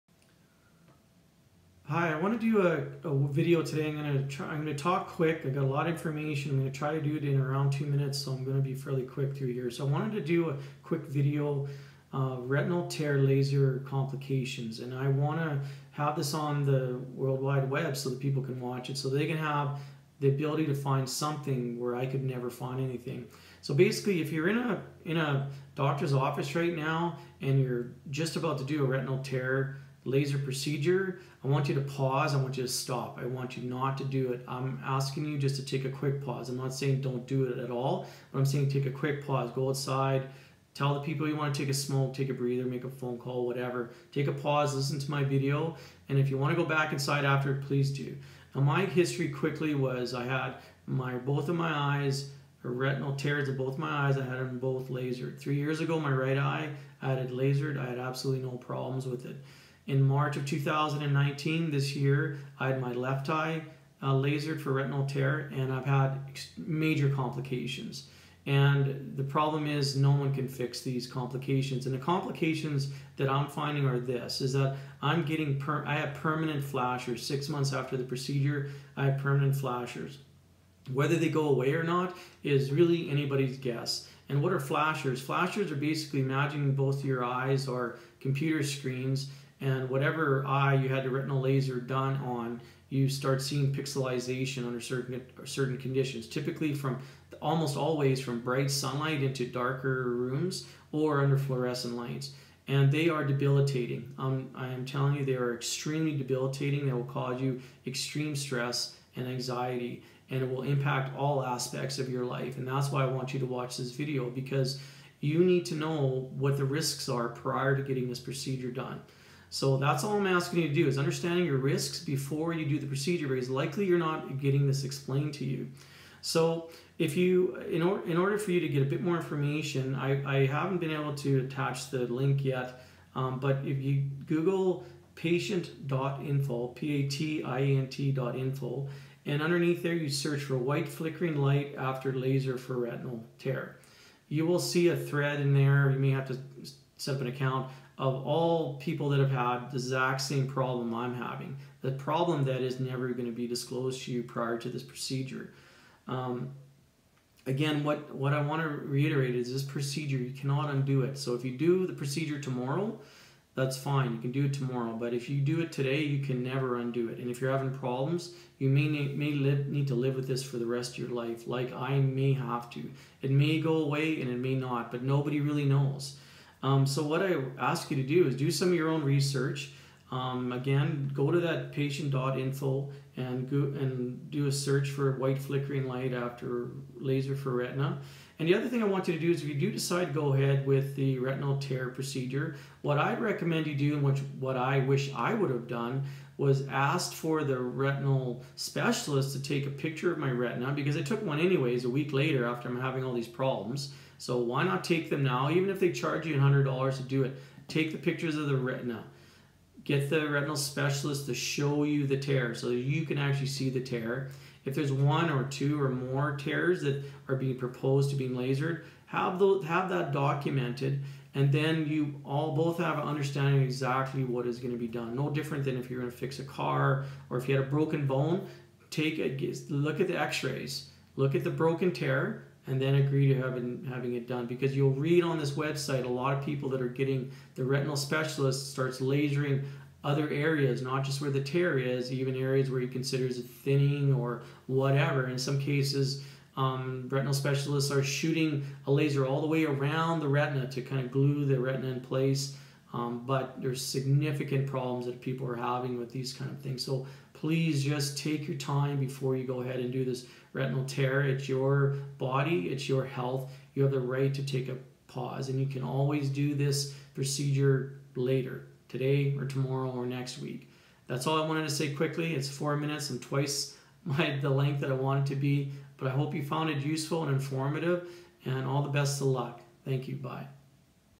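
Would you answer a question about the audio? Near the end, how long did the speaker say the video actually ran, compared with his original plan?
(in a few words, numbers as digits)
4 minutes.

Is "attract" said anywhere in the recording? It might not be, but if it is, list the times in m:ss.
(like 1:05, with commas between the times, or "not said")
not said.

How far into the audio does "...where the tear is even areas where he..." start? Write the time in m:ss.
4:01.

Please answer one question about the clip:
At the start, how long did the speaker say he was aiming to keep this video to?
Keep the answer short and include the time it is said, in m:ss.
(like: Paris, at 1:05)
2 minutes, at 0:07.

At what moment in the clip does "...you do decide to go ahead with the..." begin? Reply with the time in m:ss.
3:09.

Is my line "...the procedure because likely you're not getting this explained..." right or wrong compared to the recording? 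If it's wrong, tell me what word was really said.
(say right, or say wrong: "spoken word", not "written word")
right.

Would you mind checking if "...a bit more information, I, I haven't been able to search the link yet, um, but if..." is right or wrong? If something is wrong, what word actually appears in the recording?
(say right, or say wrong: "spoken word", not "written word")
wrong: "attach", not "search".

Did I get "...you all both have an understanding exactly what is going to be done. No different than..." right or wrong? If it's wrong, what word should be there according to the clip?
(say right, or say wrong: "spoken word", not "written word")
right.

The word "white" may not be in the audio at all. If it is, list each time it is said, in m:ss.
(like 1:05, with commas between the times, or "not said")
2:20, 3:05.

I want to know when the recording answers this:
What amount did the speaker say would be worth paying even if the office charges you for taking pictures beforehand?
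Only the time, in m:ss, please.
3:26.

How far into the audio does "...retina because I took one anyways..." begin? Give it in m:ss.
3:20.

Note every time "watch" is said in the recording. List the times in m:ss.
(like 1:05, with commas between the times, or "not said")
0:18, 1:53.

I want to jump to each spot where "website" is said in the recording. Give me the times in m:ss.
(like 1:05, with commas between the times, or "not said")
3:55.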